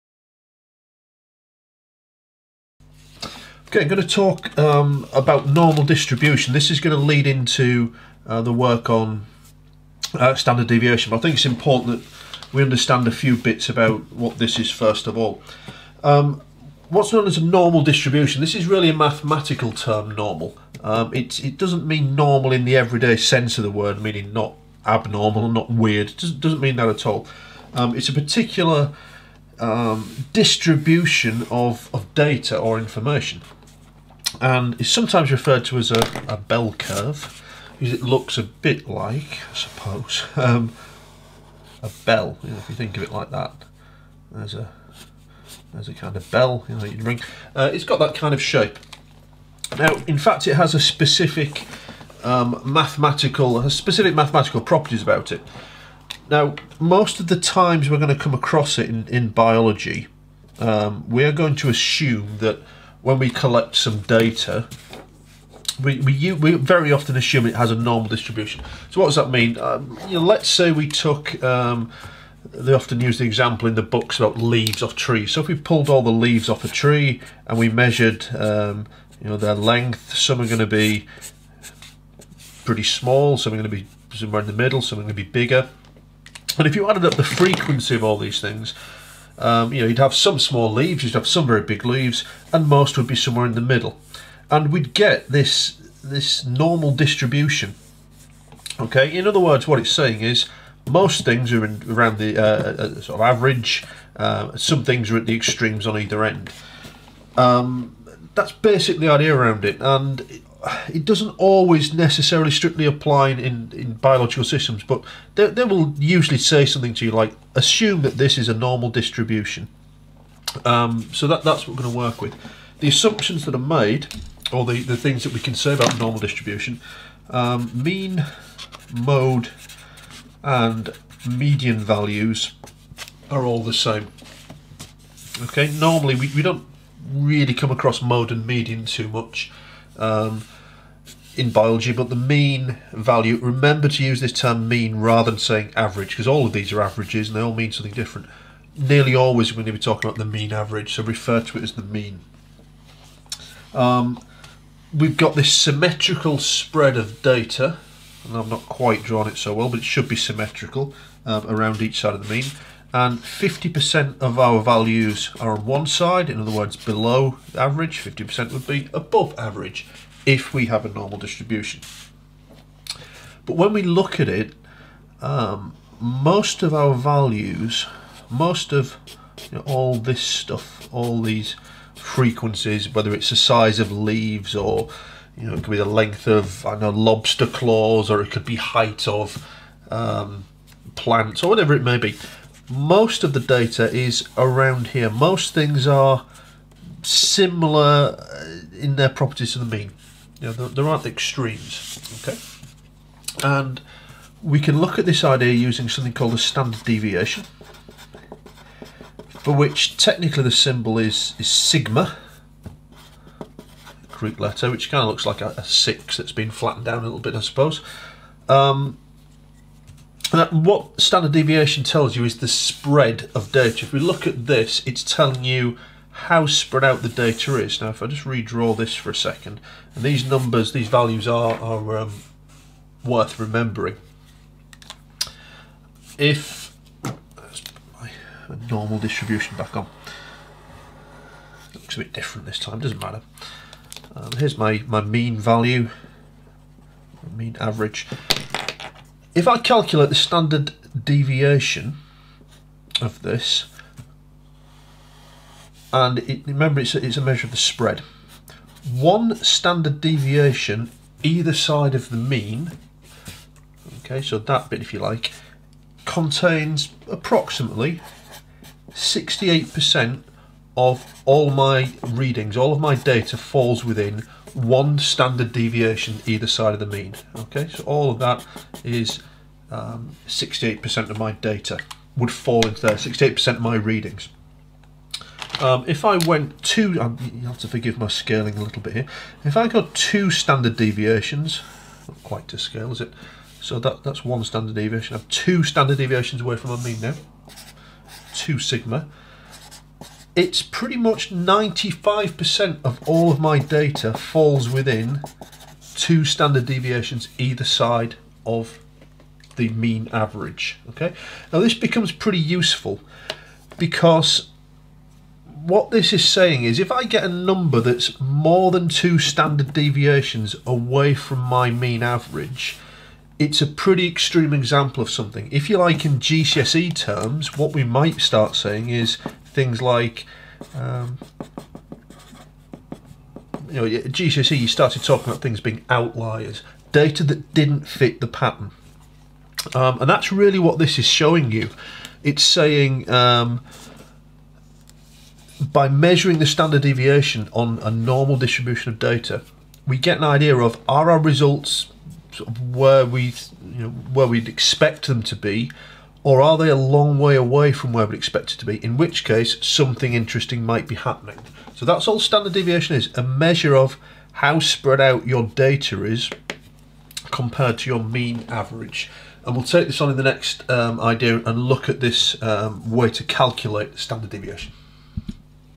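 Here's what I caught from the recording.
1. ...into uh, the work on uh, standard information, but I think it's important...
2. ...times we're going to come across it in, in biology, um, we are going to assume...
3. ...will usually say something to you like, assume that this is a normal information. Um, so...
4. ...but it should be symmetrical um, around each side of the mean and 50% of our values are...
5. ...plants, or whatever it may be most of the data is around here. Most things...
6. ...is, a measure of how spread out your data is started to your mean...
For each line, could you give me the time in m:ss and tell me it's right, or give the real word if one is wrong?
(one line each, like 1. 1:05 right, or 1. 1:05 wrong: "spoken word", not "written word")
1. 0:07 wrong: "deviation", not "information"
2. 0:57 right
3. 1:55 wrong: "distribution", not "information"
4. 2:39 right
5. 3:10 right
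6. 6:02 wrong: "compared", not "started".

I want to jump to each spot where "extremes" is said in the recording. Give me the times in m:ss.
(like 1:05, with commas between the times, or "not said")
1:45, 3:21, 5:24.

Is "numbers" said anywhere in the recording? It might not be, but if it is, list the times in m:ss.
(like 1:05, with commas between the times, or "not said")
3:50, 5:17.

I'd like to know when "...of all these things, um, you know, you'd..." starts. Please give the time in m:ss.
1:27.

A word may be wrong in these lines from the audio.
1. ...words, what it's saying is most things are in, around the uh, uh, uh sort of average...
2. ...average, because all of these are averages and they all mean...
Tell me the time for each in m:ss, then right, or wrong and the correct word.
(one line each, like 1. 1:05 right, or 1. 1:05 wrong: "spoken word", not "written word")
1. 1:39 right
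2. 2:25 right.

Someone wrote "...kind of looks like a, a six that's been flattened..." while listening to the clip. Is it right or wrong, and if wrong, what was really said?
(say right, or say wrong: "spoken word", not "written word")
right.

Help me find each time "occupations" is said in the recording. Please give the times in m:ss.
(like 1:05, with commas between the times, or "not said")
not said.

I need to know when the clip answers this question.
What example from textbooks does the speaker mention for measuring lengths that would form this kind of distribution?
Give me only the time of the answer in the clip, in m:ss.
1:14.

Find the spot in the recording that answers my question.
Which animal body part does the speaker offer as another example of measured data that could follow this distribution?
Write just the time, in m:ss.
3:06.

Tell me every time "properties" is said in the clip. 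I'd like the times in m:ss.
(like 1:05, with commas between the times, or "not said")
0:54, 3:19.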